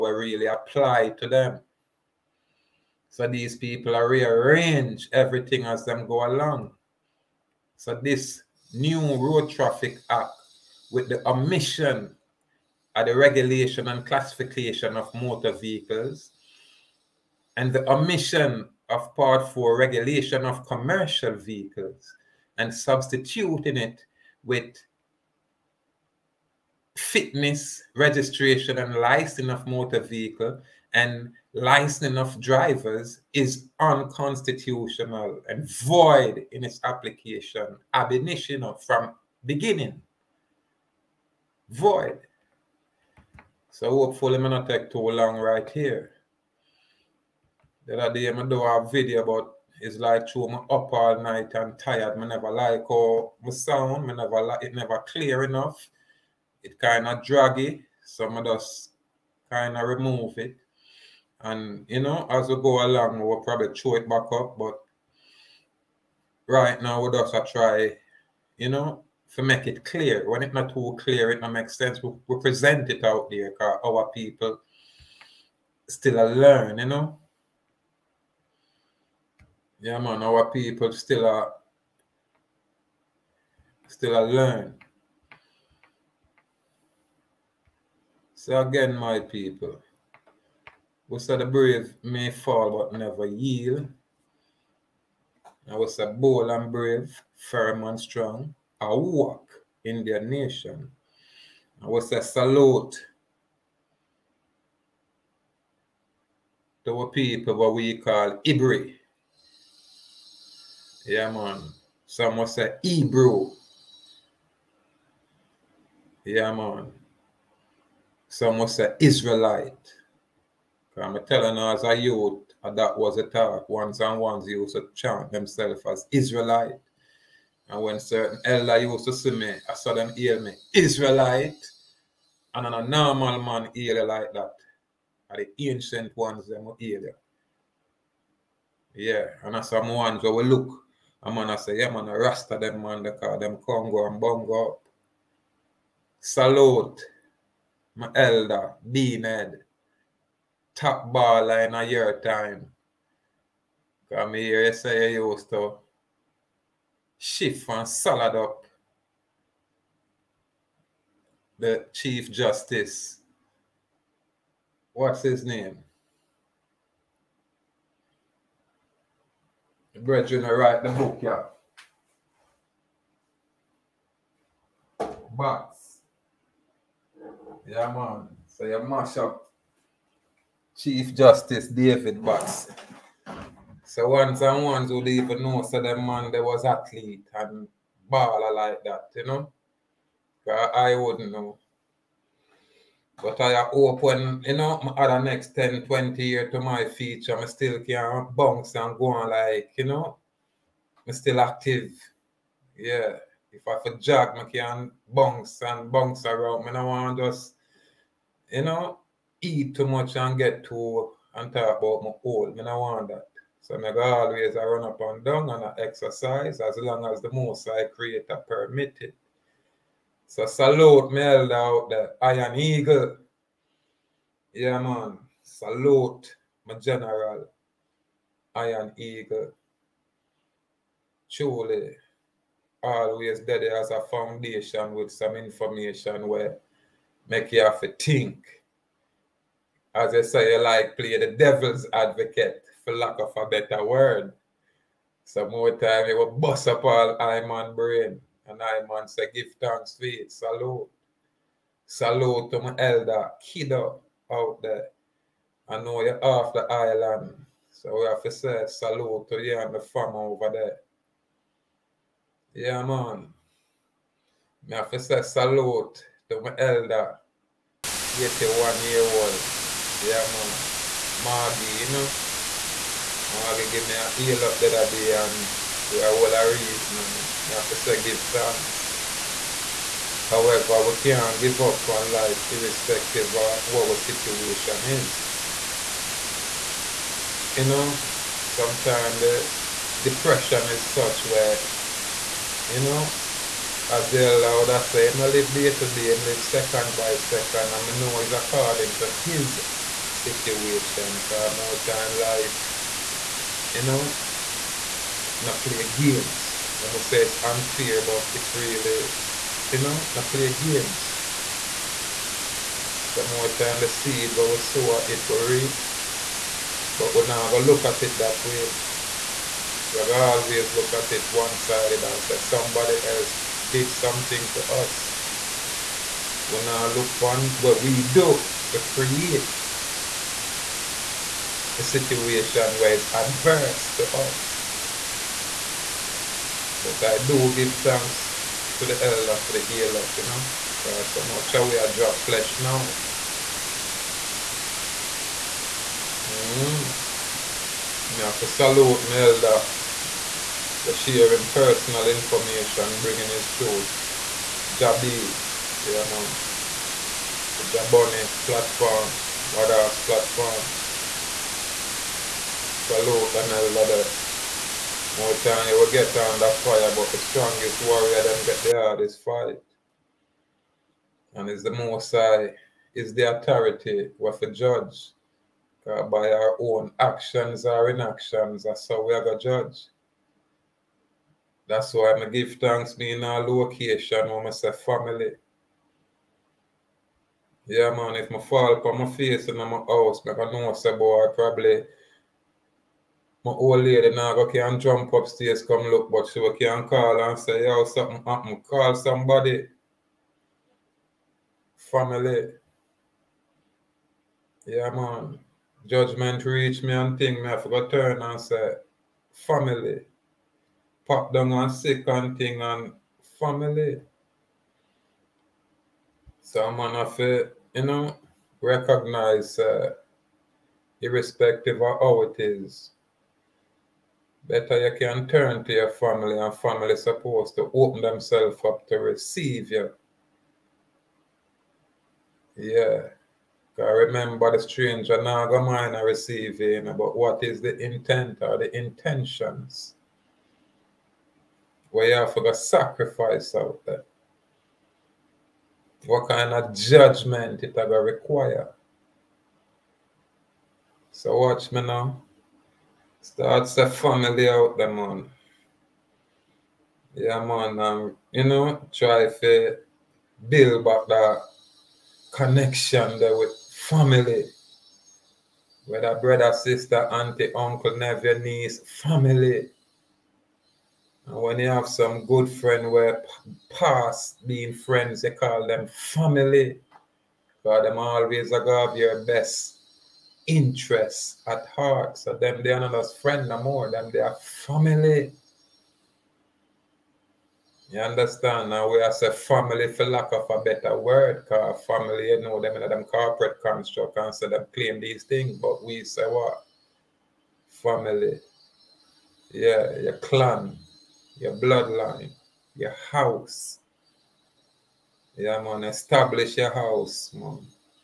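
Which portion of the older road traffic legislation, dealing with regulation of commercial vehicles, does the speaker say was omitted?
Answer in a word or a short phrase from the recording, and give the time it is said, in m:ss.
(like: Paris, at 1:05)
Part 4, at 0:19.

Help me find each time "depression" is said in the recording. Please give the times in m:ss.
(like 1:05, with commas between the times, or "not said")
4:50.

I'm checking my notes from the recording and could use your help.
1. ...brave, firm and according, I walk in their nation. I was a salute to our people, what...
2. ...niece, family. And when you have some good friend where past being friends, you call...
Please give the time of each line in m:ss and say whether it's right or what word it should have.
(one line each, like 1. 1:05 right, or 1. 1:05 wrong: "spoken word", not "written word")
1. 1:36 wrong: "strong", not "according"
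2. 7:48 right.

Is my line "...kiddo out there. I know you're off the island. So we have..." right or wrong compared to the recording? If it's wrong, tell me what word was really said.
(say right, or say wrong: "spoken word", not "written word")
right.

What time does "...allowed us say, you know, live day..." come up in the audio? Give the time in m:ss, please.
4:54.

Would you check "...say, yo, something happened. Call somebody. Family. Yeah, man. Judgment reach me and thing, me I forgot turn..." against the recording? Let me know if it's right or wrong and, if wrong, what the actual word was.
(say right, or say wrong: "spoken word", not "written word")
right.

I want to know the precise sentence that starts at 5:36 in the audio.
But I do give thanks to the elder for the heal up, you know, because so much we are drop flesh now.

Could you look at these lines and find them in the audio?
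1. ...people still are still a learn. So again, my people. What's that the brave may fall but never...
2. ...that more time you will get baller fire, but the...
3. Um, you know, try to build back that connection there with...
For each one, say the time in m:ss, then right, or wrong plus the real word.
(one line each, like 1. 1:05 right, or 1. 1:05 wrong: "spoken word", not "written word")
1. 1:20 right
2. 6:03 wrong: "under", not "baller"
3. 7:37 right.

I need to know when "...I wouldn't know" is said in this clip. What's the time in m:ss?
3:10.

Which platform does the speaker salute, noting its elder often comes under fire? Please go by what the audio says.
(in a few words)
The Jaboni platform.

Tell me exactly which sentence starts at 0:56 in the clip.
It kind of draggy, so I just kind of remove it.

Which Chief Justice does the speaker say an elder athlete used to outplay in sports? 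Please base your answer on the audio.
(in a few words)
David Box.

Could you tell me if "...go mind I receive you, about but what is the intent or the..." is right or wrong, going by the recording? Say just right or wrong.
right.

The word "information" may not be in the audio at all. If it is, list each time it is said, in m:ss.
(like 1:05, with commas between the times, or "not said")
3:55, 5:52.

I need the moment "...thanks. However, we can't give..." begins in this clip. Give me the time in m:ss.
4:38.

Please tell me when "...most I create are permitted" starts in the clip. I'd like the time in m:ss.
3:37.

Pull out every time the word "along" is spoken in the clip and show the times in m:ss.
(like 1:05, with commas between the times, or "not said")
0:06, 1:02.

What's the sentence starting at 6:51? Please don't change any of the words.
Pop down and sick and thing and family.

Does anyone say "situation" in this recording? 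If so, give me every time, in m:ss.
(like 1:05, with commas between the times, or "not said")
4:43, 5:00, 5:31.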